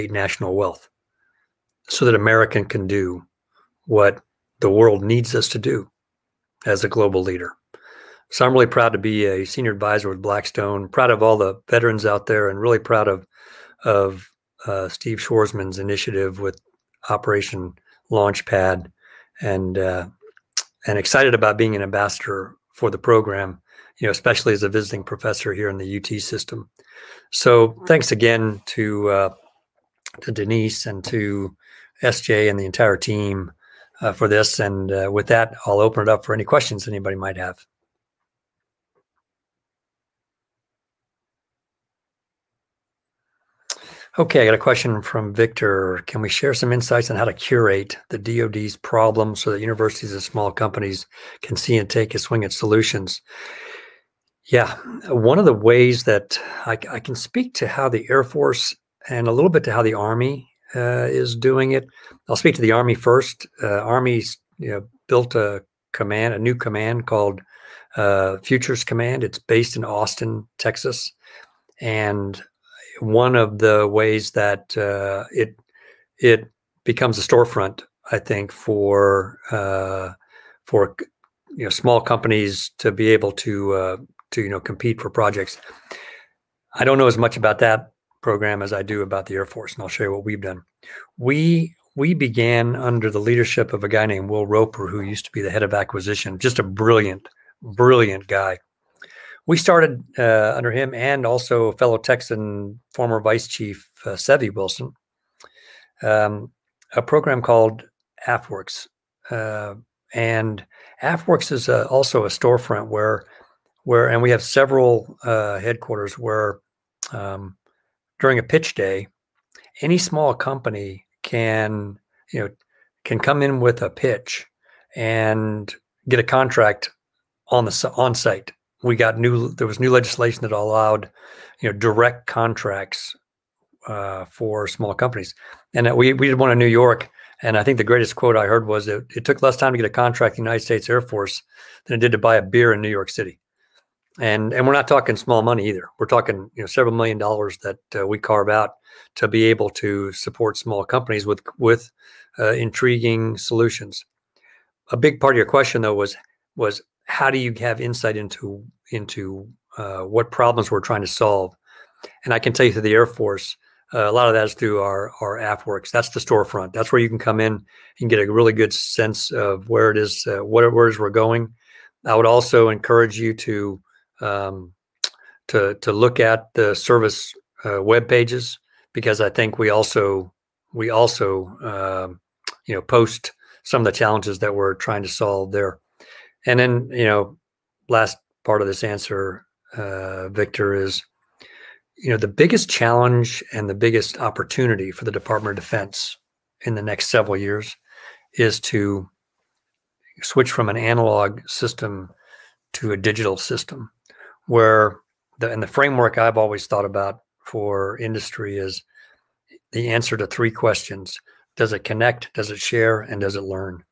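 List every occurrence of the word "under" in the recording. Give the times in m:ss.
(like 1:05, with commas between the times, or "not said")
1:32, 1:40.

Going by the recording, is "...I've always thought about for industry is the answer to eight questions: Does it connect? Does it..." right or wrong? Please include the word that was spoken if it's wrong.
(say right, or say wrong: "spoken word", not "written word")
wrong: "three", not "eight".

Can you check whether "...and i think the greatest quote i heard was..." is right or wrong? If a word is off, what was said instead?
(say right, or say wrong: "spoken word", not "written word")
right.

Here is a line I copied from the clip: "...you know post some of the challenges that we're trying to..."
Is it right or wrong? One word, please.
right.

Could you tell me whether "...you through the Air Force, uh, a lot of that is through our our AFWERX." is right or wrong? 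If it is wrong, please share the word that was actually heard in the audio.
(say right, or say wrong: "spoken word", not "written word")
right.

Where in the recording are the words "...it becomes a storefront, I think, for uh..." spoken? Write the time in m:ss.
1:16.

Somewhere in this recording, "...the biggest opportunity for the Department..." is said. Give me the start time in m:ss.
3:13.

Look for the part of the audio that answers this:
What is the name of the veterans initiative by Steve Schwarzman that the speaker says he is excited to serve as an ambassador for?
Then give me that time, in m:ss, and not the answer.
0:17.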